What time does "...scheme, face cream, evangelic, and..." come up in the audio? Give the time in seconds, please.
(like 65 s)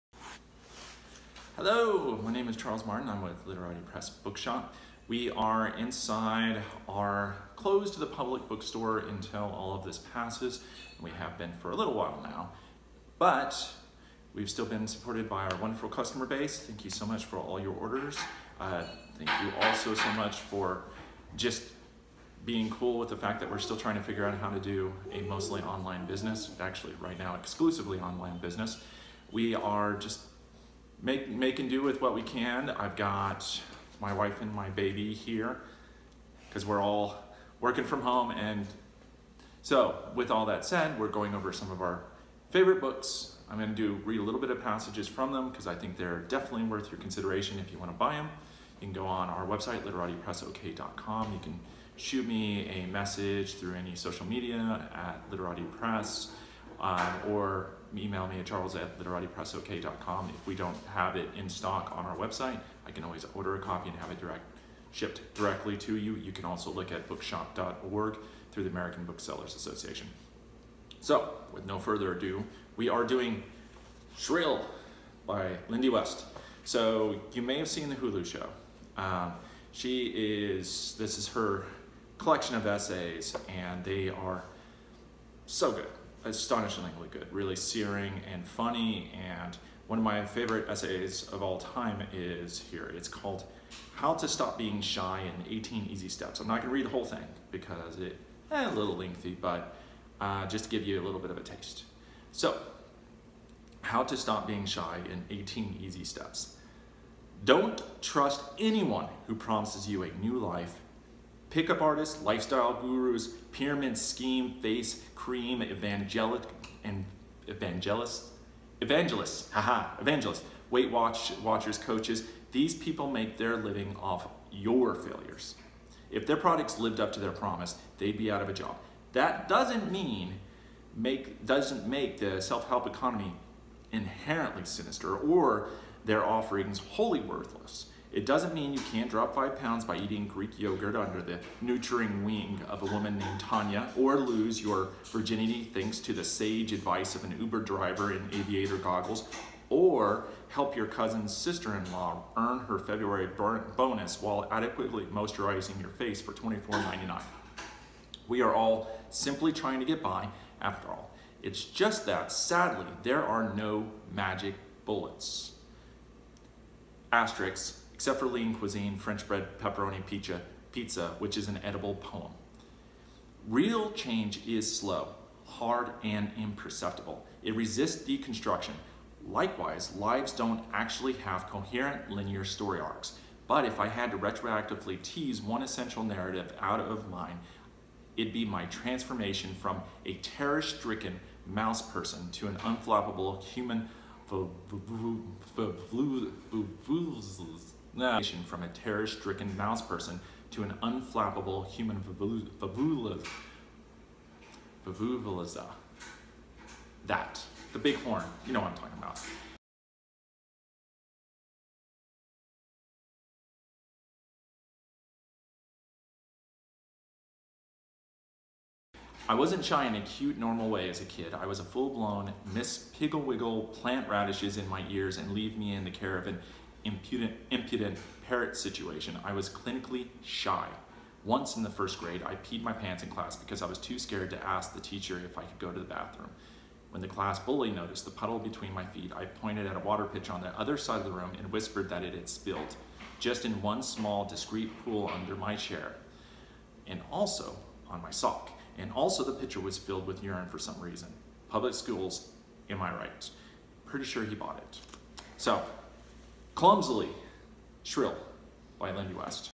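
113 s.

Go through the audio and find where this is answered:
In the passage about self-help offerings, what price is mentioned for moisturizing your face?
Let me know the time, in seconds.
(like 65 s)
156 s.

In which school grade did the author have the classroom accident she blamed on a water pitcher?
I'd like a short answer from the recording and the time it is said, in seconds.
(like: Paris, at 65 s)
First grade, at 231 s.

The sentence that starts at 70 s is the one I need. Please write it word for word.
So, with no further ado, we are doing Shrill by Lindy West.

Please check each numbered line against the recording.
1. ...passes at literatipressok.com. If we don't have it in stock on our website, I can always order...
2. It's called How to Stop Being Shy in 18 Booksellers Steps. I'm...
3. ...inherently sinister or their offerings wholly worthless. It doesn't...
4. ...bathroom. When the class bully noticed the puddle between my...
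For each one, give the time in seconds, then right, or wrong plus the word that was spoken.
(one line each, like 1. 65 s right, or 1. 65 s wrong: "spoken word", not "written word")
1. 58 s wrong: "charles", not "passes"
2. 92 s wrong: "Easy", not "Booksellers"
3. 133 s right
4. 235 s right.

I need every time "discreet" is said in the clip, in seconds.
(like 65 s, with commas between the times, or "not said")
244 s.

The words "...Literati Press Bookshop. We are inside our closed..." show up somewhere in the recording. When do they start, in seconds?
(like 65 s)
3 s.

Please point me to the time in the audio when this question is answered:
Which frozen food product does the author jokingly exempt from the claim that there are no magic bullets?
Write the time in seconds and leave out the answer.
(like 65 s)
168 s.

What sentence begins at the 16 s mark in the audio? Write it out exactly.
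Thank you so much for all your orders.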